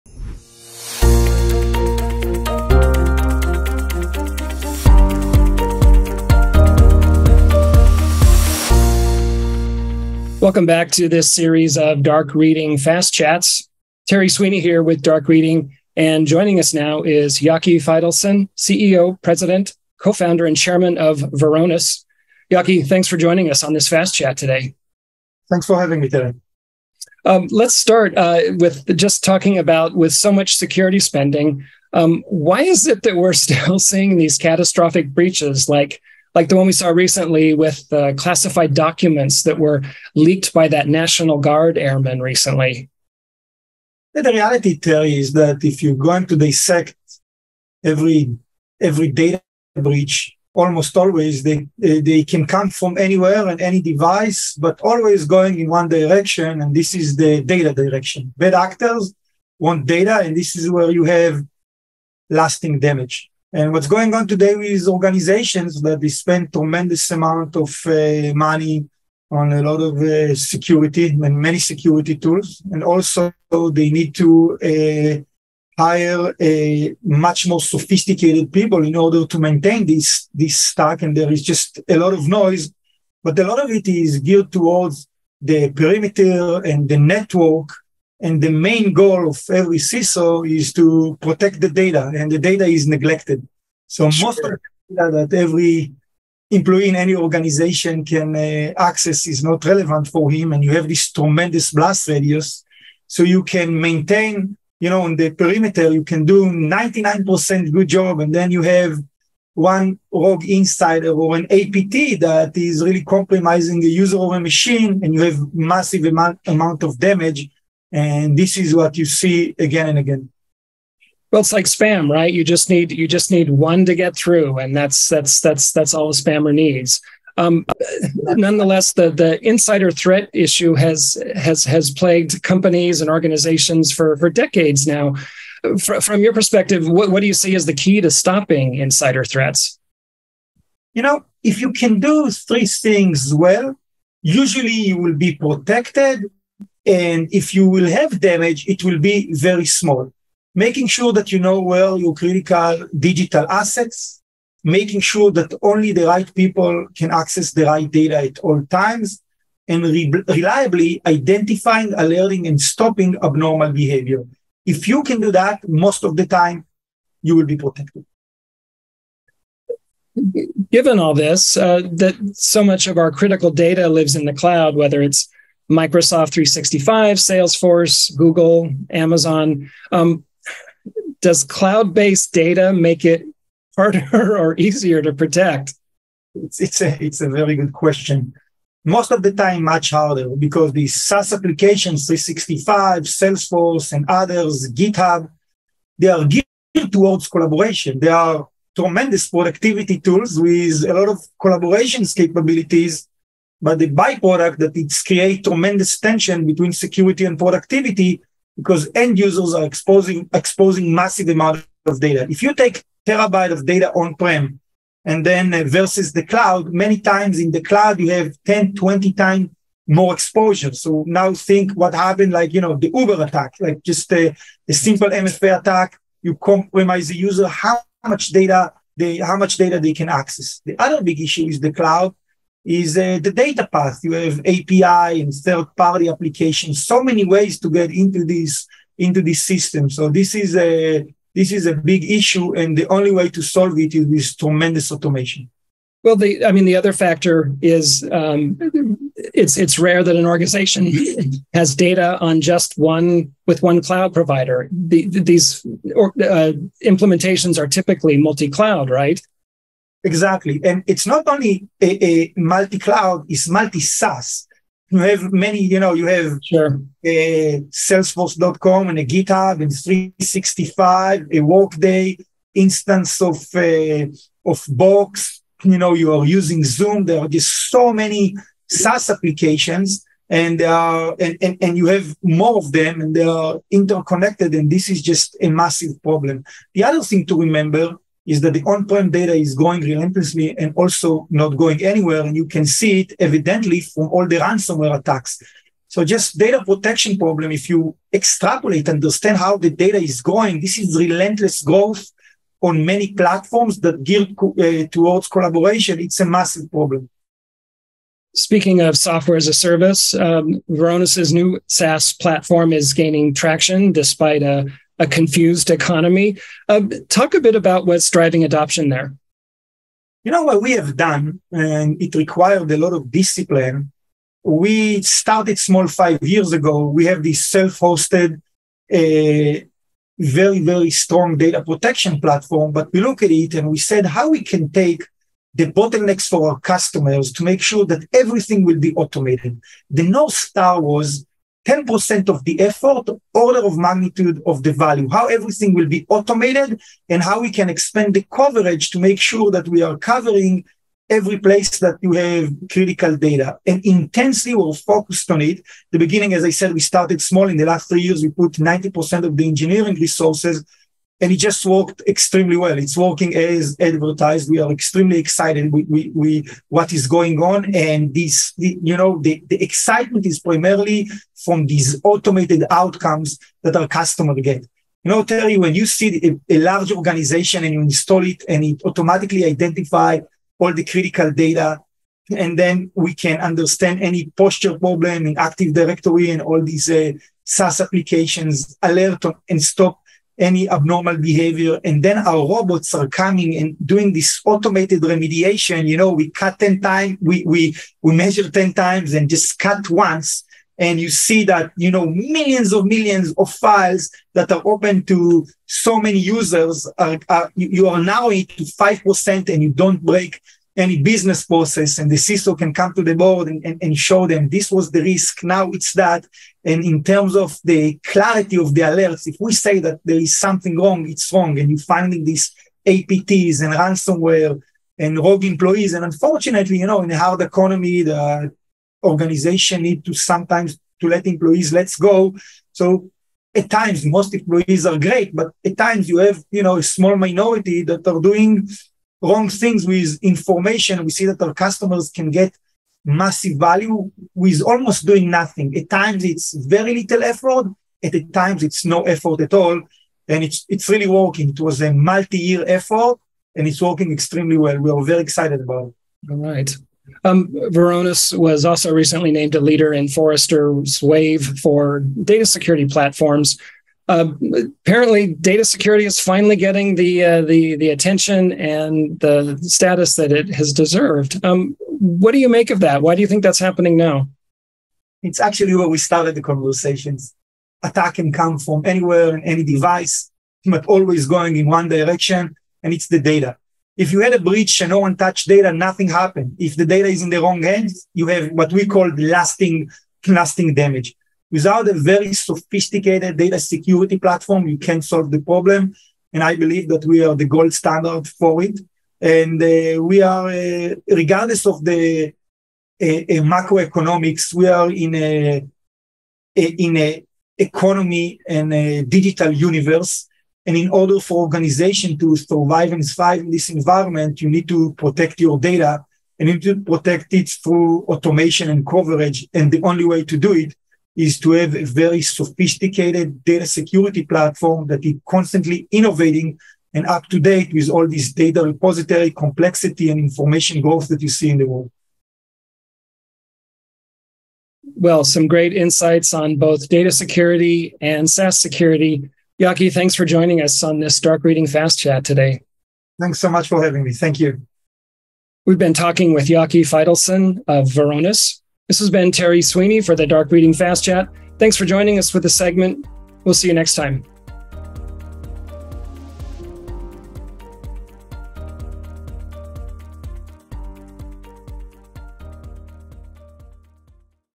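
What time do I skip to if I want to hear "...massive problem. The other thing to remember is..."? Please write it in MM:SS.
04:45.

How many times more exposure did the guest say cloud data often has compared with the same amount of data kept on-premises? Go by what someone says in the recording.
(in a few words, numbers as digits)
10 to 20 times.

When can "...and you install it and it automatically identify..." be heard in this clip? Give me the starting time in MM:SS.
06:17.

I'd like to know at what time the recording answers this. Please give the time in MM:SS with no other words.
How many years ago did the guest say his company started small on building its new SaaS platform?
05:25.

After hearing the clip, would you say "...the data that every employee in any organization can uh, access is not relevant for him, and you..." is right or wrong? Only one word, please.
right.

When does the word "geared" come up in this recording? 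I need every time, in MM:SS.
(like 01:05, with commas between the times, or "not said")
01:24, 03:16, 05:04.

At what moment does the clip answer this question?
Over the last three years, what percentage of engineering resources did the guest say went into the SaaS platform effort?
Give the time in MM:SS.
05:58.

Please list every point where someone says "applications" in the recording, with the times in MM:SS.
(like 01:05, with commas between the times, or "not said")
03:11, 03:56, 04:39, 06:27.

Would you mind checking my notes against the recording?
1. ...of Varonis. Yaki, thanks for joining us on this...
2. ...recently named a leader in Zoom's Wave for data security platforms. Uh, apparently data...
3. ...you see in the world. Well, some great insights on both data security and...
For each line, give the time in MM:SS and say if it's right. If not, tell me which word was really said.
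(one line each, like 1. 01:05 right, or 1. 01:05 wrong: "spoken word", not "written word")
1. 00:20 right
2. 07:38 wrong: "Forrester", not "Zoom"
3. 08:51 right.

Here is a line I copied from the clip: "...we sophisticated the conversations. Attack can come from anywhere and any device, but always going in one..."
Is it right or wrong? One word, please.
wrong.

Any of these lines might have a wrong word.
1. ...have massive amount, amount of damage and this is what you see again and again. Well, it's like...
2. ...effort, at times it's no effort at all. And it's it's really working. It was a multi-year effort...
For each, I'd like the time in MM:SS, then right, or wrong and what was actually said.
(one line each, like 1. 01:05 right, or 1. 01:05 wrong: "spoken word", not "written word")
1. 01:55 right
2. 07:27 right.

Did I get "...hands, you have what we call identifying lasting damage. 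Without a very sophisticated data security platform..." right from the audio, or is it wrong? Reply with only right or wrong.
wrong.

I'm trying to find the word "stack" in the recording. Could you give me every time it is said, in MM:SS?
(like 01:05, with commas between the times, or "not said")
01:20.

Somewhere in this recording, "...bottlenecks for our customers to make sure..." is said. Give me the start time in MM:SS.
05:35.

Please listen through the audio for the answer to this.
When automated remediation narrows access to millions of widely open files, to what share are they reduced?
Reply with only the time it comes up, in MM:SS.
06:48.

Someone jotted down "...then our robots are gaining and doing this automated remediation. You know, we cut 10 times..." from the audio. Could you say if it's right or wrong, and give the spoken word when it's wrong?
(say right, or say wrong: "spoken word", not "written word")
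wrong: "coming", not "gaining".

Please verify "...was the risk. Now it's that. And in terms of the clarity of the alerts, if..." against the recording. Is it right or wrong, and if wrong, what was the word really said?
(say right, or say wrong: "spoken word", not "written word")
right.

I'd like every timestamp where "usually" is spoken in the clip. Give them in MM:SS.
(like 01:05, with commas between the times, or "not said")
02:24.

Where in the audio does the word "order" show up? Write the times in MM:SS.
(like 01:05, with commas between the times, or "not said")
01:18, 05:43, 08:30.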